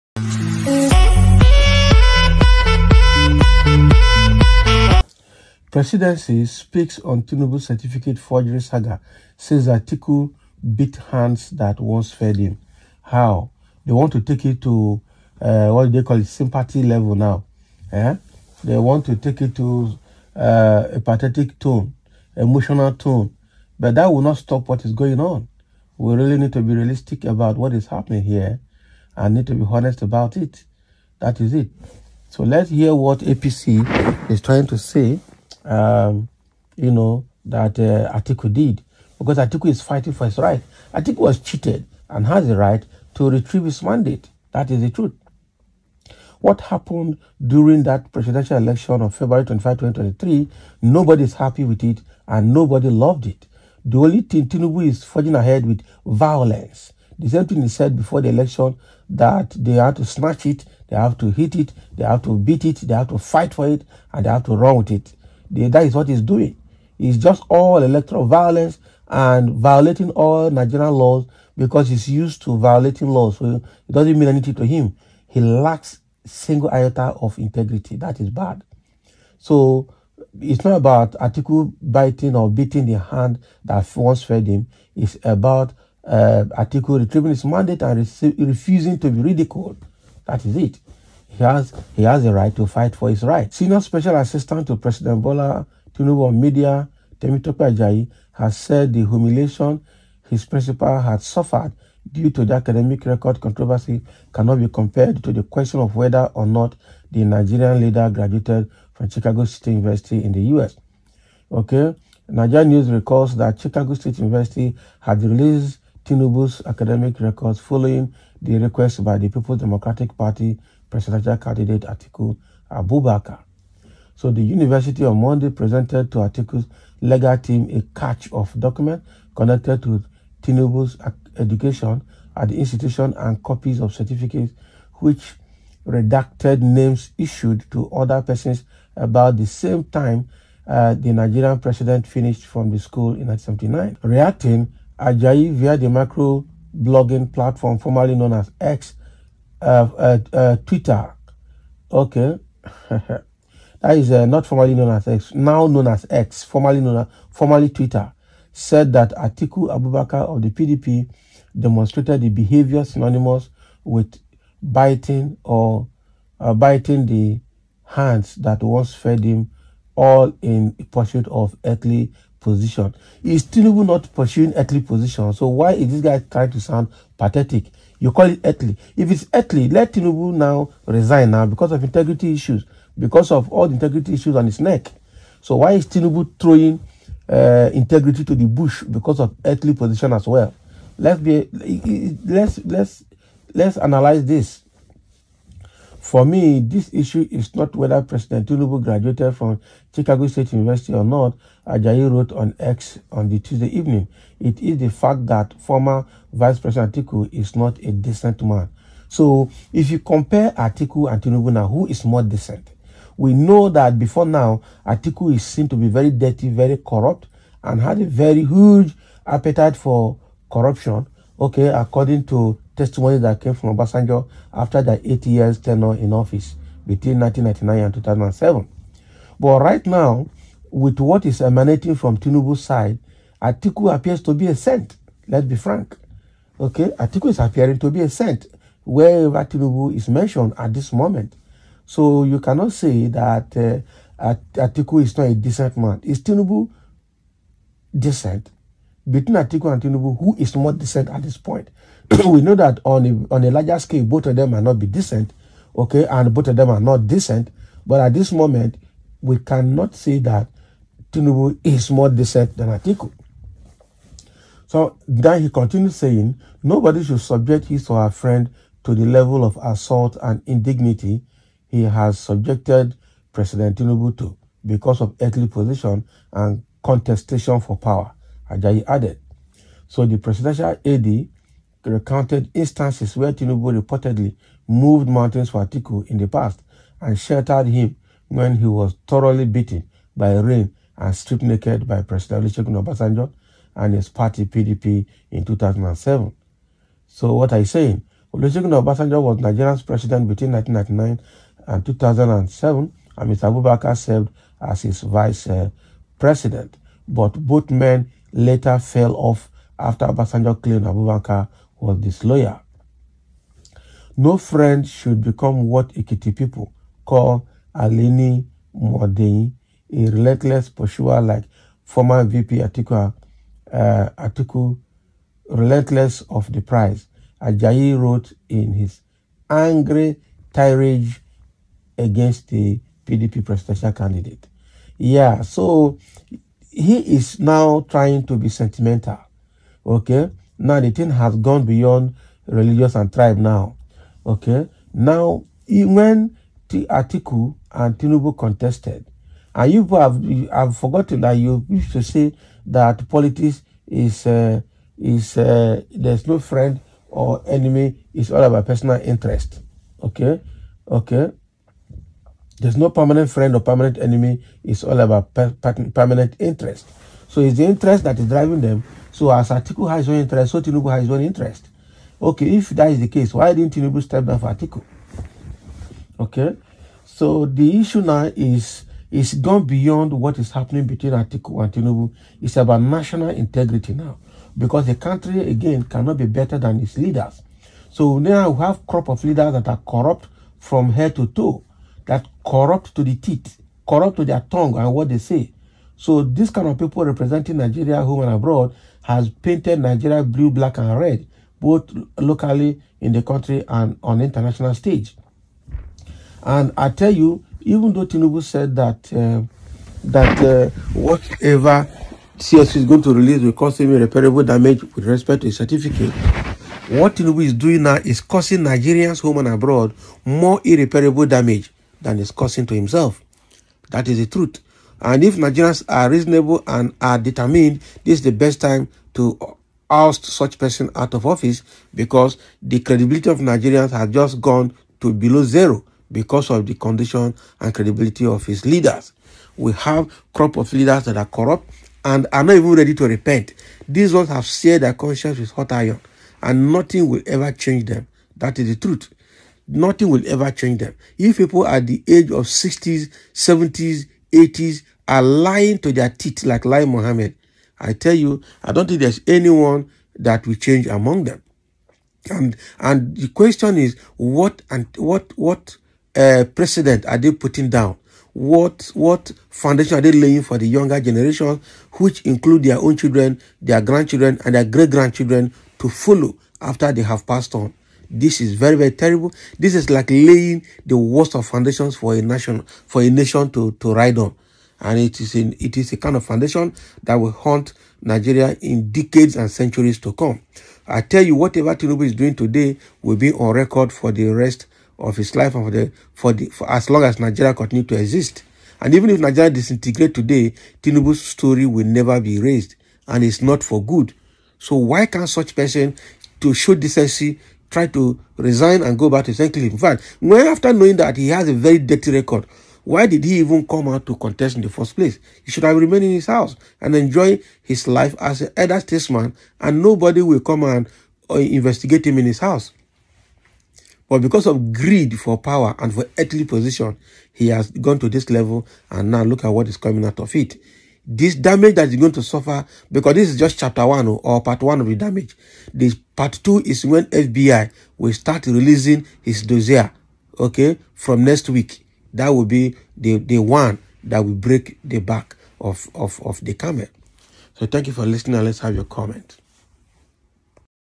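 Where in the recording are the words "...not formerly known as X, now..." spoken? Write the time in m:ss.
2:34.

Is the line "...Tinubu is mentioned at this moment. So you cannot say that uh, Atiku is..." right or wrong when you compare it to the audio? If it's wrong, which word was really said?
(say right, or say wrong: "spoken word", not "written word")
right.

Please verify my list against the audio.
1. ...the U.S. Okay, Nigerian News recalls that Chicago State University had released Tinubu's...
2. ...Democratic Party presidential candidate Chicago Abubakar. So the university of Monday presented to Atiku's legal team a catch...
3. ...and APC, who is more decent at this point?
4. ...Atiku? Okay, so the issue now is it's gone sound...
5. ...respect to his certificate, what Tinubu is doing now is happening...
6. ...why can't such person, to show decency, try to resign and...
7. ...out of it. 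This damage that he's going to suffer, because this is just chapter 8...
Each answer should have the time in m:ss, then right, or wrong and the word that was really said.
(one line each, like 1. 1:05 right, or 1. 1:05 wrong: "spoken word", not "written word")
1. 1:50 right
2. 1:59 wrong: "Atiku", not "Chicago"
3. 4:09 wrong: "Tinubu", not "APC"
4. 6:14 wrong: "beyond", not "sound"
5. 6:55 wrong: "causing", not "happening"
6. 8:24 right
7. 8:50 wrong: "1", not "8".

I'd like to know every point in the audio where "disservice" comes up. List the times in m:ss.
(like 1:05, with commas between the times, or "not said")
not said.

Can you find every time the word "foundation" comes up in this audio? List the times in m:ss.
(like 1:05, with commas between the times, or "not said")
7:49, 8:01, 8:06.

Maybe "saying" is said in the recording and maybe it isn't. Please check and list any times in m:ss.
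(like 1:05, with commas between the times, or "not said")
4:25, 4:57.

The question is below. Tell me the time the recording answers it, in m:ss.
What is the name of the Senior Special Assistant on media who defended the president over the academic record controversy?
1:37.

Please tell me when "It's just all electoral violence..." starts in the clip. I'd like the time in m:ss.
1:06.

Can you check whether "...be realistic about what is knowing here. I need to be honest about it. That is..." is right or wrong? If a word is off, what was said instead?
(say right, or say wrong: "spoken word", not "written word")
wrong: "happening", not "knowing".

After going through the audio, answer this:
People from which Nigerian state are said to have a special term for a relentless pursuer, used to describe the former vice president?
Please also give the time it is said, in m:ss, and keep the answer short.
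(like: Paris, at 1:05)
Ekiti, at 5:15.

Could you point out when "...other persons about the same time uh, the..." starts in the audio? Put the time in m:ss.
2:17.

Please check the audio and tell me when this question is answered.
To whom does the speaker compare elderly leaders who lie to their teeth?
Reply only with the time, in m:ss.
7:36.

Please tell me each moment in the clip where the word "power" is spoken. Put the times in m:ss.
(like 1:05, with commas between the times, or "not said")
4:37, 8:45.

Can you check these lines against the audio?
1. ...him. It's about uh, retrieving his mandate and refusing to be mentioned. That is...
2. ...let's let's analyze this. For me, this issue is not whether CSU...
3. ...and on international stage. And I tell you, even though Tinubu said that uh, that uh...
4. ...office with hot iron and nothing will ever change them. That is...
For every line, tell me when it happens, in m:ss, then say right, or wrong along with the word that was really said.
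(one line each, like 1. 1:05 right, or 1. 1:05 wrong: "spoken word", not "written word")
1. 1:24 wrong: "ridiculed", not "mentioned"
2. 3:12 wrong: "President", not "CSU"
3. 6:43 right
4. 7:24 wrong: "conscience", not "office".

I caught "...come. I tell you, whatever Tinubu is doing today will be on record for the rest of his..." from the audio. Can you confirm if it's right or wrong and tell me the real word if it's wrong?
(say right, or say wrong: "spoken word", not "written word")
right.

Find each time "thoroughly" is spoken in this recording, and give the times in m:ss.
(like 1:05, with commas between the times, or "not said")
4:49.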